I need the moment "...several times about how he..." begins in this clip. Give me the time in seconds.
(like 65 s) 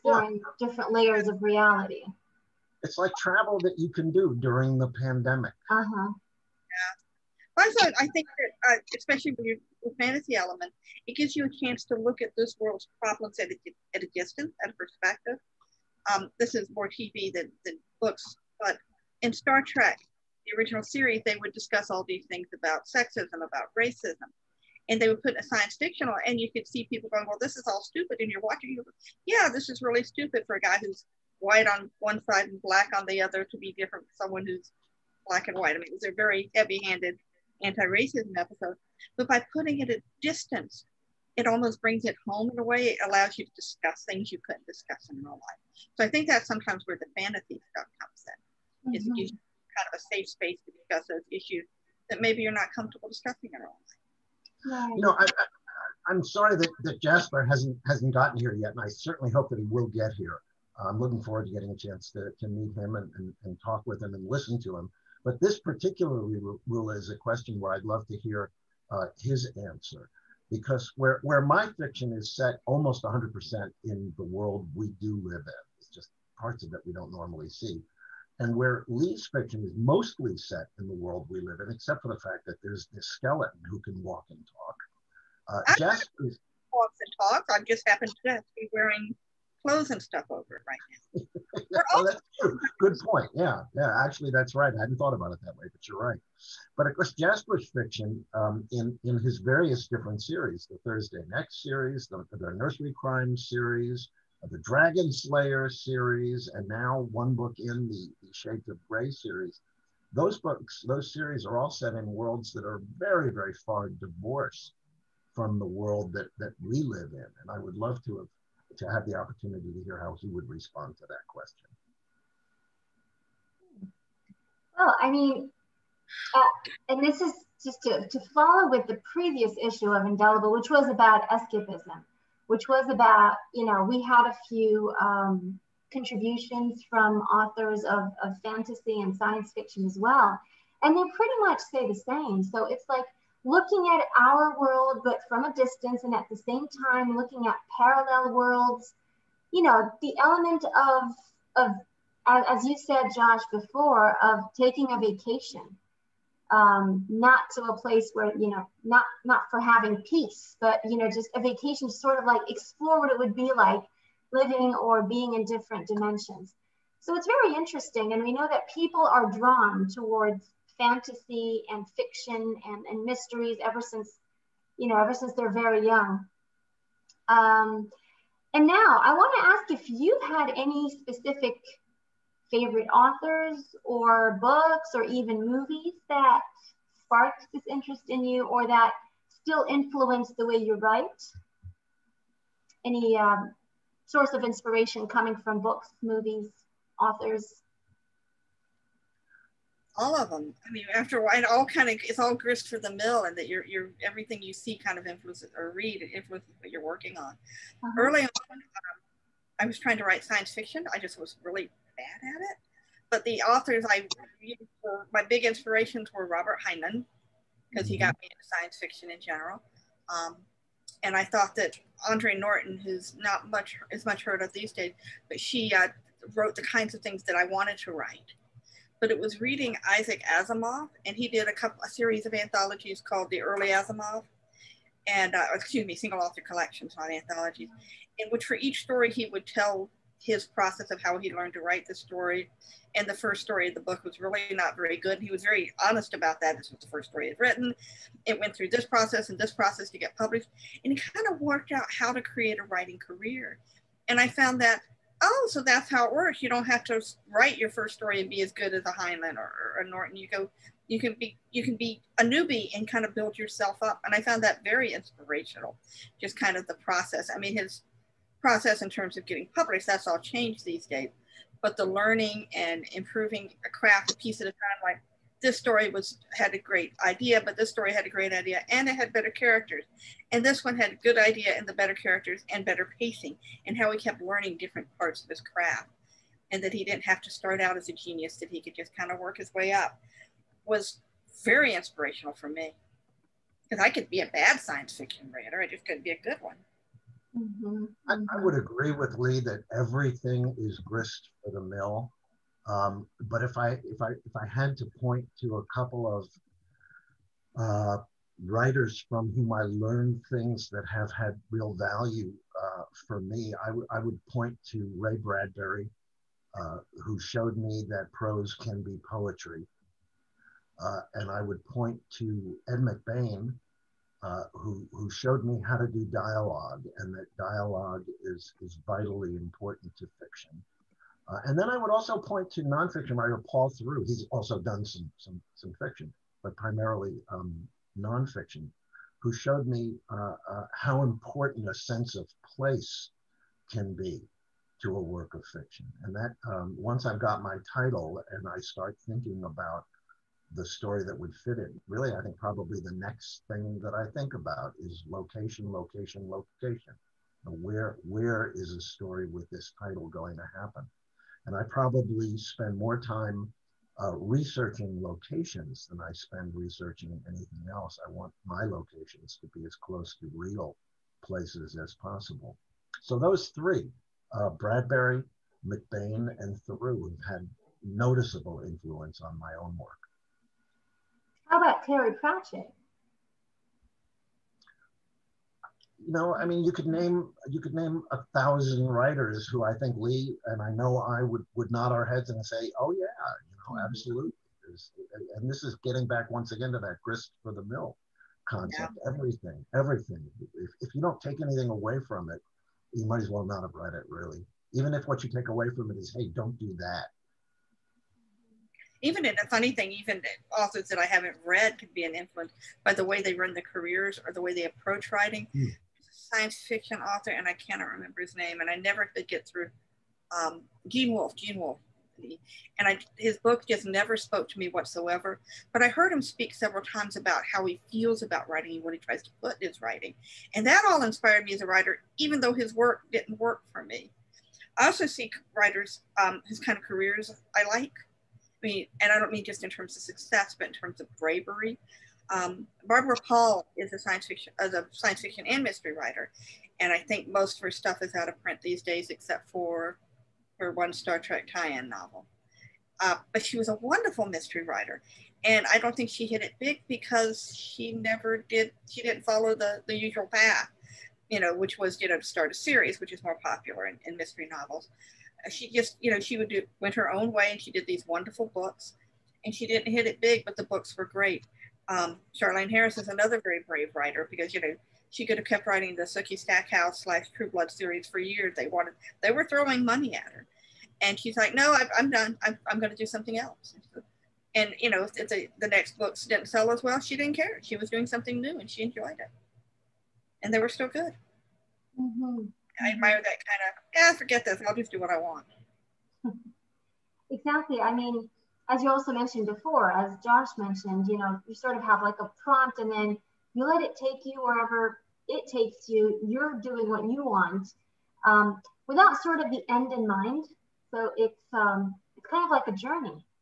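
426 s.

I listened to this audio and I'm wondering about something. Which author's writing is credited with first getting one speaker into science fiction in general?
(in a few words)
Robert Heinlein.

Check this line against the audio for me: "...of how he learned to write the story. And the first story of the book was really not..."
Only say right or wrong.
right.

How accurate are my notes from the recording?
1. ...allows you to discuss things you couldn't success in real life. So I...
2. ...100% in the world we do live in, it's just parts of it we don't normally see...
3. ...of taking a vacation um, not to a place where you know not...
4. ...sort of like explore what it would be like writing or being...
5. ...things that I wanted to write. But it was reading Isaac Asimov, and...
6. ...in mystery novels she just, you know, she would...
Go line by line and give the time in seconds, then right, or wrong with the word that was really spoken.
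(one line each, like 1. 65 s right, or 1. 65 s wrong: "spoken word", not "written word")
1. 43 s wrong: "discuss", not "success"
2. 73 s right
3. 154 s right
4. 161 s wrong: "living", not "writing"
5. 227 s right
6. 464 s right.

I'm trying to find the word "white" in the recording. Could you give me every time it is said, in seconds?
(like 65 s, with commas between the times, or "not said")
31 s, 35 s.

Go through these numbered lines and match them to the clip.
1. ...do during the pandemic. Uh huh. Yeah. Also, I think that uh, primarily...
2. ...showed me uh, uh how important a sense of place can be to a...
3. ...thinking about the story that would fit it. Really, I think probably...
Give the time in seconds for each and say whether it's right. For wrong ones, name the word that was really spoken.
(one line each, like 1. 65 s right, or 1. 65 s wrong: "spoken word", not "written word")
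1. 4 s wrong: "especially", not "primarily"
2. 339 s right
3. 349 s right.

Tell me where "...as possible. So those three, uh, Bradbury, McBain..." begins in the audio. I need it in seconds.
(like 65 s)
371 s.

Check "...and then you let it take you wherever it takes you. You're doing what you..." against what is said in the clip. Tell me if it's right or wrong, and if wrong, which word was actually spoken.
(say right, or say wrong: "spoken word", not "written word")
right.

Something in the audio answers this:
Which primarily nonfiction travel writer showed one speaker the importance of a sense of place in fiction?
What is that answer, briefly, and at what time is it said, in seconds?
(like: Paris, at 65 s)
Paul Theroux, at 333 s.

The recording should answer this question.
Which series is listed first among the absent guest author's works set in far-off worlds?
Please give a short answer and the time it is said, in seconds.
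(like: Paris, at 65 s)
Thursday Next, at 100 s.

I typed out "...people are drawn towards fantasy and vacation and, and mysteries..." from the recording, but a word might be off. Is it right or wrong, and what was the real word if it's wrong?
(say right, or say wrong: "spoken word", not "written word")
wrong: "fiction", not "vacation".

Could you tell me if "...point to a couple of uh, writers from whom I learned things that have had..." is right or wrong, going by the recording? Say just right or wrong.
right.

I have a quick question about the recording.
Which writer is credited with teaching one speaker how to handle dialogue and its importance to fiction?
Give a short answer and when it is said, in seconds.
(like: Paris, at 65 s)
Ed McBain, at 322 s.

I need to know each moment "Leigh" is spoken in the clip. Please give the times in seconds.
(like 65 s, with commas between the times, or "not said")
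78 s, 299 s, 389 s.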